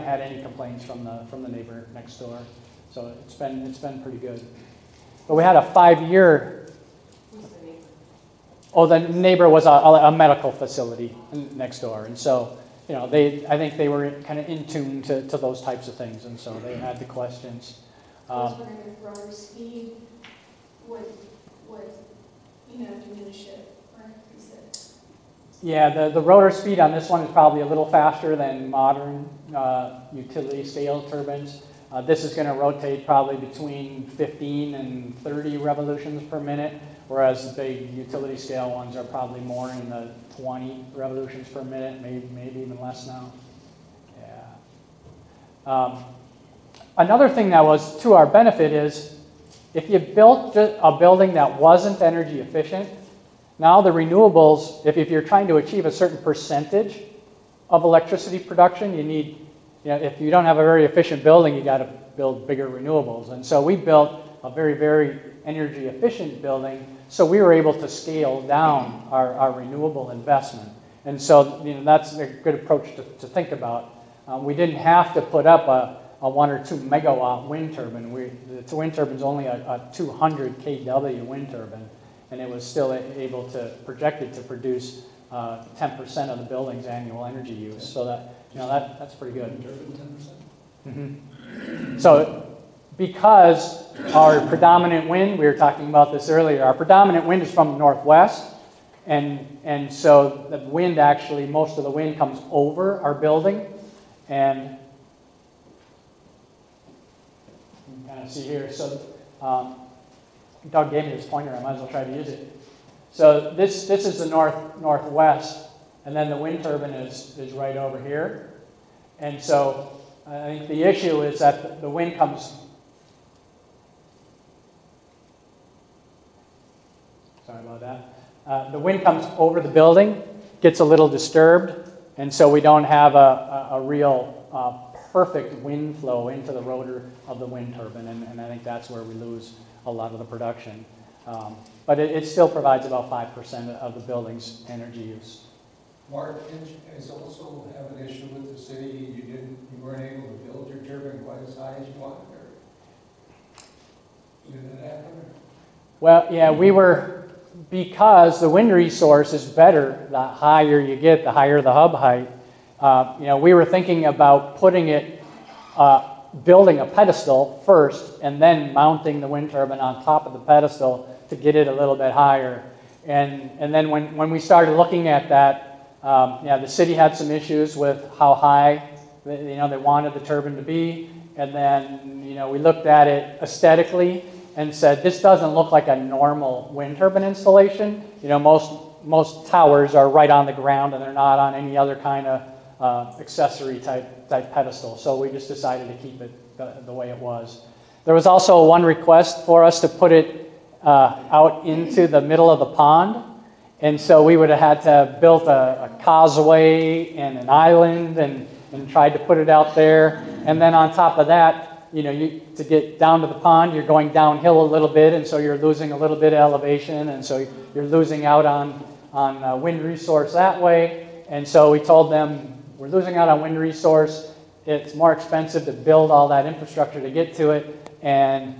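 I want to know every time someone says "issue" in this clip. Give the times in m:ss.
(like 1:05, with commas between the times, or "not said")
2:00, 2:28, 2:57.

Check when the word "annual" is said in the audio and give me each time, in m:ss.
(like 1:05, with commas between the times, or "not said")
1:26.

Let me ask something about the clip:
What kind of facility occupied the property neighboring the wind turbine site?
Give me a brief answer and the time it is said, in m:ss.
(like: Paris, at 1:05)
medical facility, at 0:10.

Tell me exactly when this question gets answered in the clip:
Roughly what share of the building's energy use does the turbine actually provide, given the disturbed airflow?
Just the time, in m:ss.
2:23.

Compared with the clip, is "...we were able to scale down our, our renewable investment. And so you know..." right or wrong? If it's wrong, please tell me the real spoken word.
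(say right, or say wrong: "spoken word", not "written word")
right.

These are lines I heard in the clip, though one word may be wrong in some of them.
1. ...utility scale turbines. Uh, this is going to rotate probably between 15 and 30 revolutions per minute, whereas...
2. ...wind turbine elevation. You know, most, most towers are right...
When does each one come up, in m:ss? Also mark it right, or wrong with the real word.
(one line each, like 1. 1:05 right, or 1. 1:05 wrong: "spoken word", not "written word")
1. 0:30 right
2. 3:06 wrong: "installation", not "elevation".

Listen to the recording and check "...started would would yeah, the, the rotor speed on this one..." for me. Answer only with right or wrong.
wrong.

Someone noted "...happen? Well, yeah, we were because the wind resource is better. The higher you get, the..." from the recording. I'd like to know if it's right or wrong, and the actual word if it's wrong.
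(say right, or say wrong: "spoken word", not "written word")
right.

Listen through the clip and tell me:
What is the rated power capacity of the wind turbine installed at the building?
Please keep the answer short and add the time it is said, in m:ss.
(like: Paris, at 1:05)
200 kW, at 1:19.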